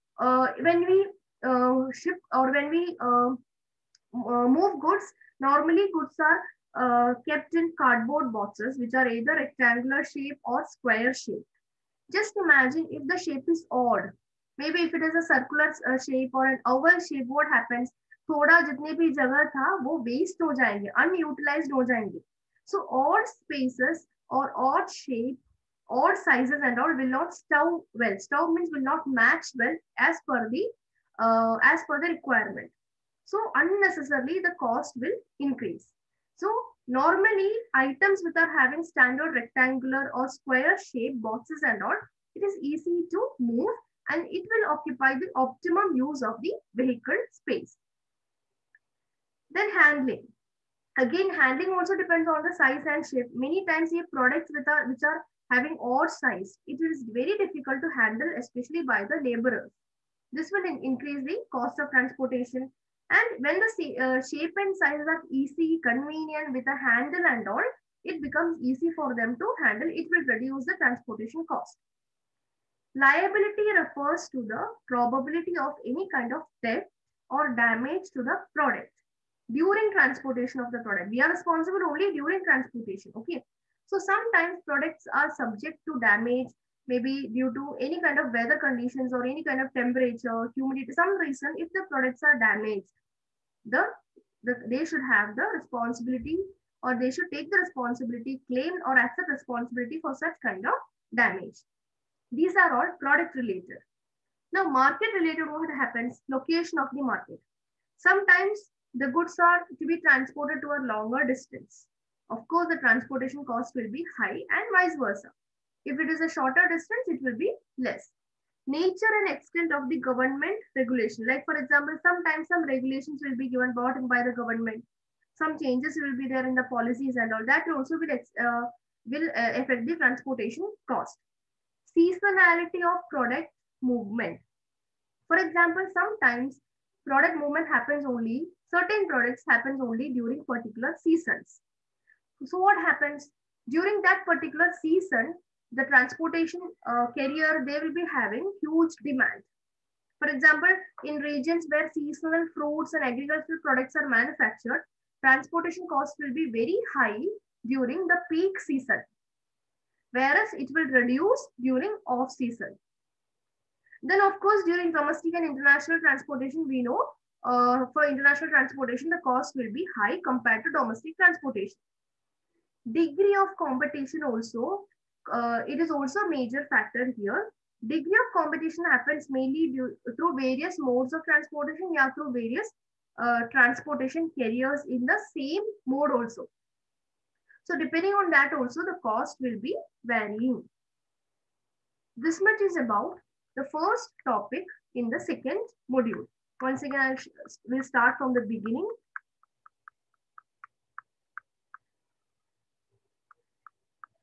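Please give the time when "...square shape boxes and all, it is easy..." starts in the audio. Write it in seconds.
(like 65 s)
40 s.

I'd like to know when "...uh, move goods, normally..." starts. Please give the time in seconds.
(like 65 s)
3 s.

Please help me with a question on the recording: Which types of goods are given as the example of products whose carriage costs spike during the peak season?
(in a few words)
seasonal fruits and agricultural products.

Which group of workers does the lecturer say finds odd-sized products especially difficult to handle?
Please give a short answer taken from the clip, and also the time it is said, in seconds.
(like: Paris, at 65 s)
laborers, at 59 s.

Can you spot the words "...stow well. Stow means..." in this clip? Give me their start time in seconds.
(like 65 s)
27 s.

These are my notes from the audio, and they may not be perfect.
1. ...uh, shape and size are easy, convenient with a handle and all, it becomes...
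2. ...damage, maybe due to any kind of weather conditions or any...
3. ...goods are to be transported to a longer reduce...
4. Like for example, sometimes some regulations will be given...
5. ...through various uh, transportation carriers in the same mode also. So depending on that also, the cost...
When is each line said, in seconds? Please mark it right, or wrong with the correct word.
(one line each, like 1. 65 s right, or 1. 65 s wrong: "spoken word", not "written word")
1. 63 s right
2. 85 s right
3. 109 s wrong: "distance", not "reduce"
4. 121 s right
5. 182 s right.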